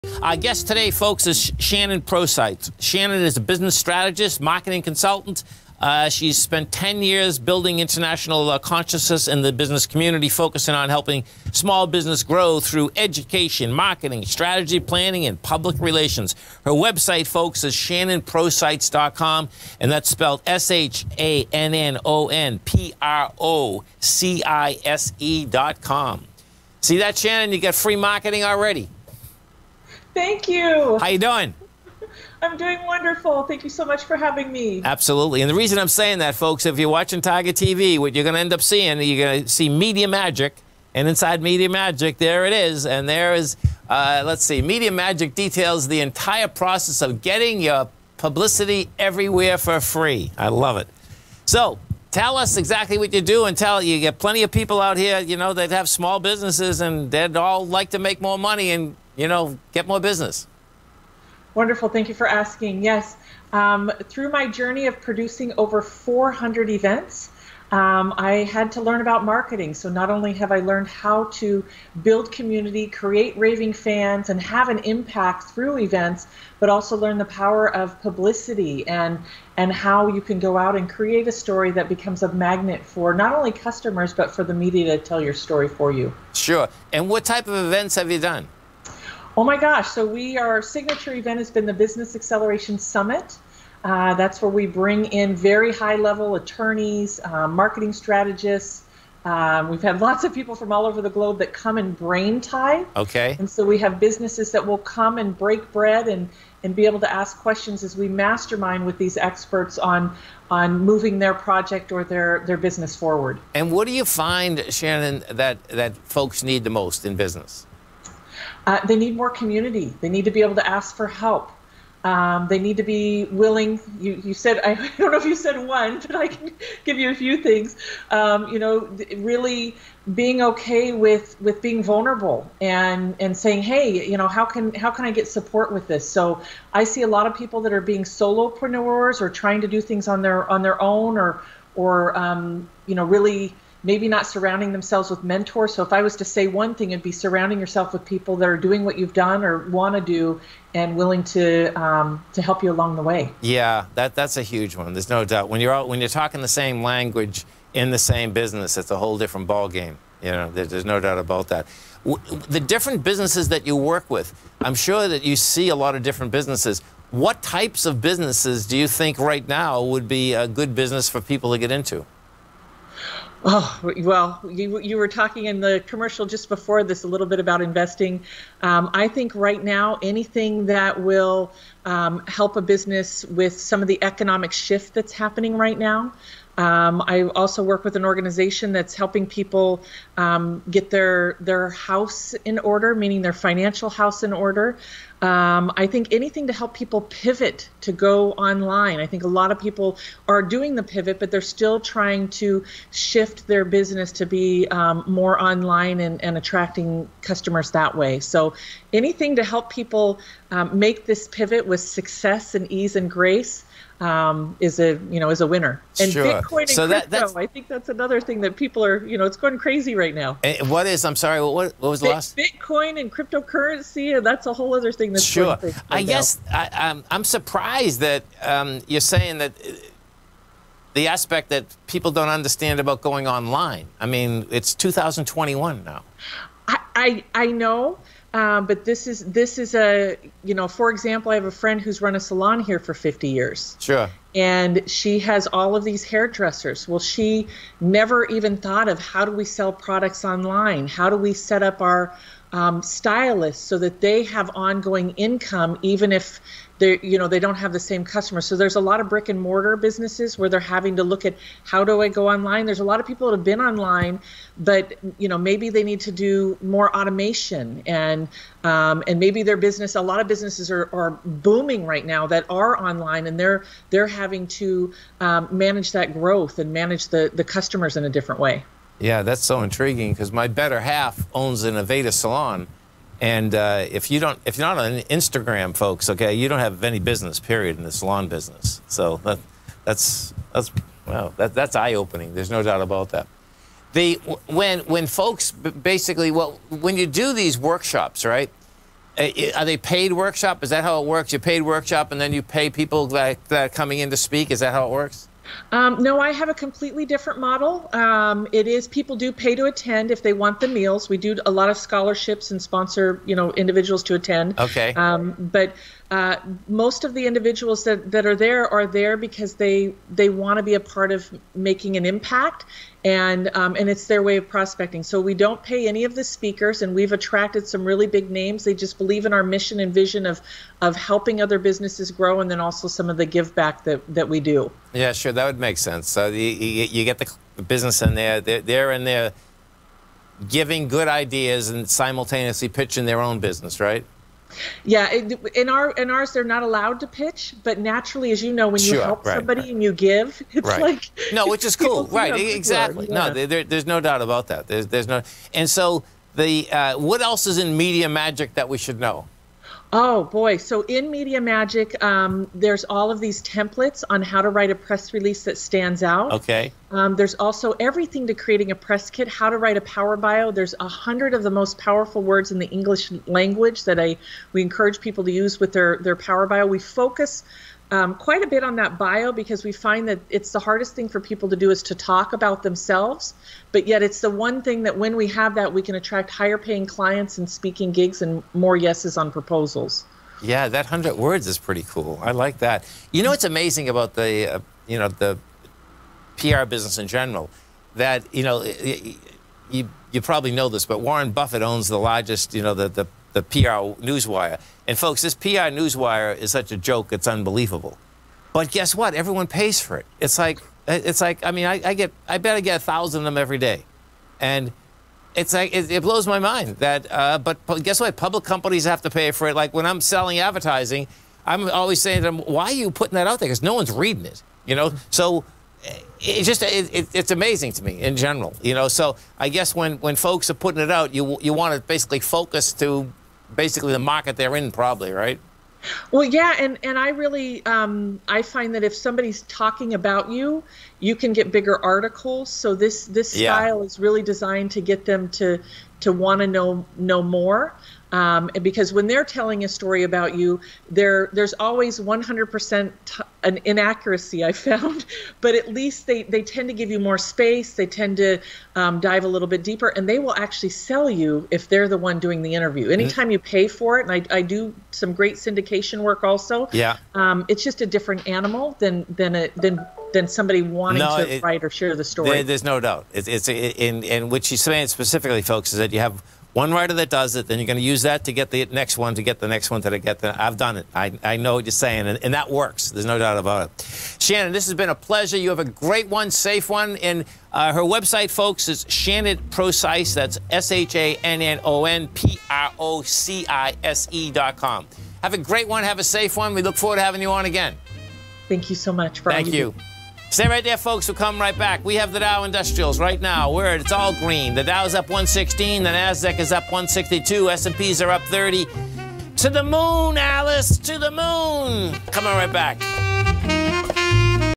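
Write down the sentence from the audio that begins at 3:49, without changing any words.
Uh, the aspect that people don't understand about going online.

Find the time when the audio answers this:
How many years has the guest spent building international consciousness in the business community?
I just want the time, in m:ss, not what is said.
0:06.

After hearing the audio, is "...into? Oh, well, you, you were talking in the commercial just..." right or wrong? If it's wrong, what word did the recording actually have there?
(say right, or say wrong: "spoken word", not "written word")
right.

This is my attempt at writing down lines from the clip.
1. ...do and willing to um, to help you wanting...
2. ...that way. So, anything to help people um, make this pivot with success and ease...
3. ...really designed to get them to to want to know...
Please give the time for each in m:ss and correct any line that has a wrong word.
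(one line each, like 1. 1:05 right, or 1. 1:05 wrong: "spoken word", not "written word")
1. 2:30 wrong: "along", not "wanting"
2. 3:27 right
3. 7:23 right.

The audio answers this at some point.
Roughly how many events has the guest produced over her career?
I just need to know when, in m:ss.
1:05.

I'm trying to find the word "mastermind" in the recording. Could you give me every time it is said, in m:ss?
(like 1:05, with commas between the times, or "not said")
1:48.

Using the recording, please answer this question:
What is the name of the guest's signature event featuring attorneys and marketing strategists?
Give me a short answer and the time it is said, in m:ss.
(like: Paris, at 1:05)
Business Acceleration Summit, at 1:31.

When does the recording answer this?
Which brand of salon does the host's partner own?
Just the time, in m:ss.
4:41.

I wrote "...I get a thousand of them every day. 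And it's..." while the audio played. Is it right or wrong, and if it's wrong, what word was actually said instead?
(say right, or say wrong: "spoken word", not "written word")
right.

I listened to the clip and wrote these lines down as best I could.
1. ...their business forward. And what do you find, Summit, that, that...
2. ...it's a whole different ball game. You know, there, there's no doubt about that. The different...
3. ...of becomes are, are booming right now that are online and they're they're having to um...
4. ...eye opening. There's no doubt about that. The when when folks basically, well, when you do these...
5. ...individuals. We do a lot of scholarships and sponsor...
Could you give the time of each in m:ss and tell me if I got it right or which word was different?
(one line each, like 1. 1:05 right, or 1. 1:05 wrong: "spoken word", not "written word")
1. 1:52 wrong: "Shannon", not "Summit"
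2. 2:38 right
3. 4:30 wrong: "businesses", not "becomes"
4. 4:51 right
5. 5:10 wrong: "meals", not "individuals".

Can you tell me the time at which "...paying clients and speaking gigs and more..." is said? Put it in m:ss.
6:26.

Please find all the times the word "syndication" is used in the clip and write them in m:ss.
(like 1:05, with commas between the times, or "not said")
7:45.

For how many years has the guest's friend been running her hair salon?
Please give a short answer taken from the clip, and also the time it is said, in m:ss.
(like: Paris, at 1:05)
50, at 4:02.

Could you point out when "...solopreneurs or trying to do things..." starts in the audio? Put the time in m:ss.
2:18.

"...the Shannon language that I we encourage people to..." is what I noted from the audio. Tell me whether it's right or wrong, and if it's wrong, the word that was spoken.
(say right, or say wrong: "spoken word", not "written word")
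wrong: "English", not "Shannon".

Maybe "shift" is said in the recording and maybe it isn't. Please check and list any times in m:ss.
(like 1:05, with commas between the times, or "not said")
3:04, 3:22.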